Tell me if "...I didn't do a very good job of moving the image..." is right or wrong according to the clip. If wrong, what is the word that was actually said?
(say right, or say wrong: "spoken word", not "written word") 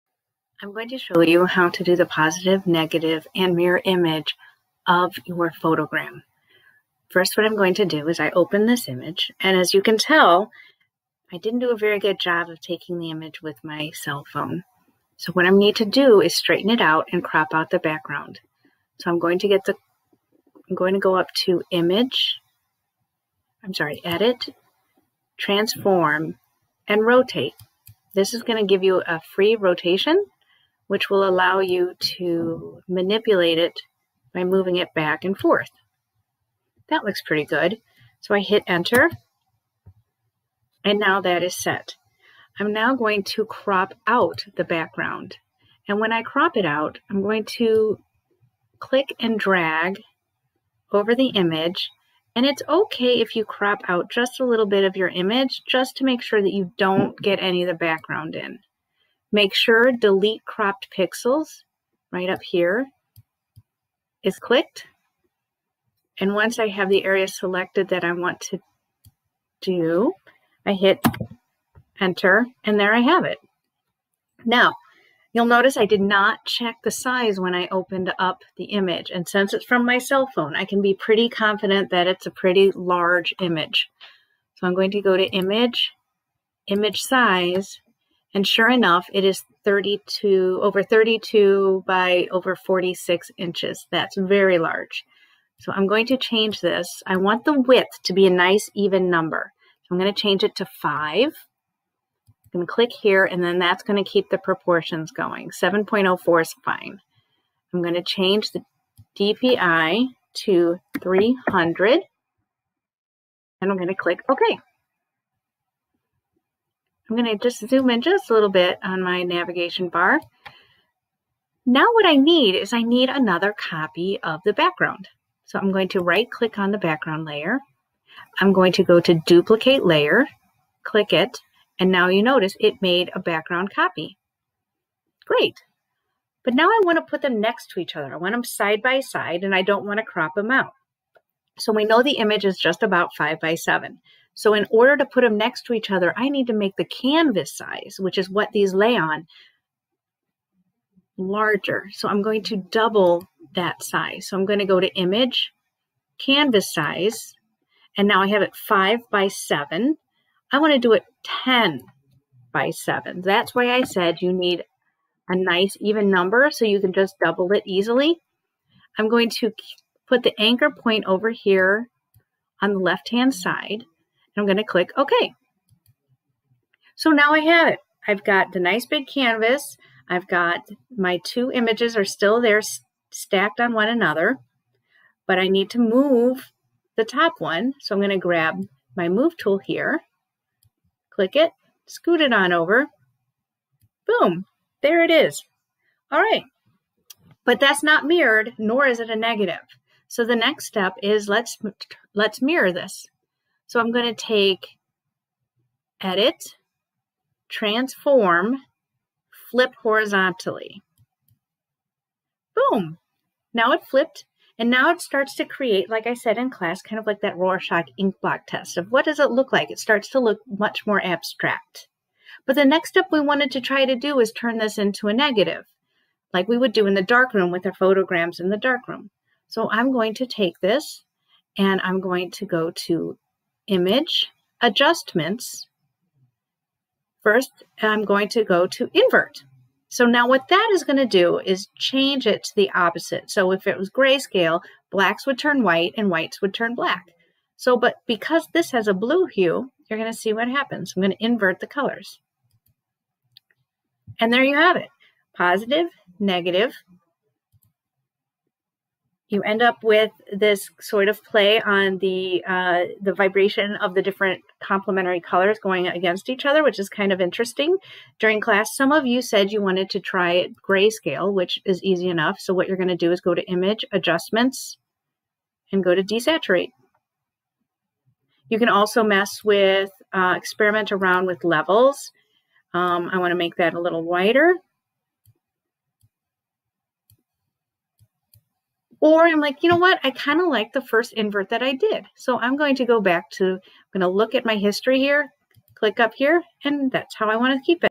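wrong: "taking", not "moving".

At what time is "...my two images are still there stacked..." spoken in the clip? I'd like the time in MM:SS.
03:00.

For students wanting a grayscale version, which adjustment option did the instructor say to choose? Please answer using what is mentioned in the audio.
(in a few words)
Desaturate.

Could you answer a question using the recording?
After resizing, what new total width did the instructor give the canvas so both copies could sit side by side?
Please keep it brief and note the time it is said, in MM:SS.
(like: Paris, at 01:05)
10, at 02:41.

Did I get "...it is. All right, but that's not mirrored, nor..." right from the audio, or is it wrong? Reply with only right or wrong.
right.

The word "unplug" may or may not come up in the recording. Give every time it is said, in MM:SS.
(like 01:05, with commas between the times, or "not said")
not said.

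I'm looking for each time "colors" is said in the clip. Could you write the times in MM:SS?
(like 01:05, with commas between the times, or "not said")
04:11, 04:25.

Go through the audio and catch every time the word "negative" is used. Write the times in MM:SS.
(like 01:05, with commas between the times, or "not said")
00:02, 03:19, 03:45, 04:16.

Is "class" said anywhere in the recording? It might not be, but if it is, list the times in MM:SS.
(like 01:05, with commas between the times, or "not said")
03:36, 04:28.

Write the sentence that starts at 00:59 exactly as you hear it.
Make sure delete cropped pixels right up here is clicked.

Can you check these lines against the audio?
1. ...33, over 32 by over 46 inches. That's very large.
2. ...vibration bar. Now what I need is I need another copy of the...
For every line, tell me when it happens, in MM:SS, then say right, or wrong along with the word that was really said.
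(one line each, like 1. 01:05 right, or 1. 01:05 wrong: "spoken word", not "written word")
1. 01:29 wrong: "32", not "33"
2. 01:59 wrong: "navigation", not "vibration".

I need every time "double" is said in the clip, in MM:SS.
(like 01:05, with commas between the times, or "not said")
02:32, 02:47.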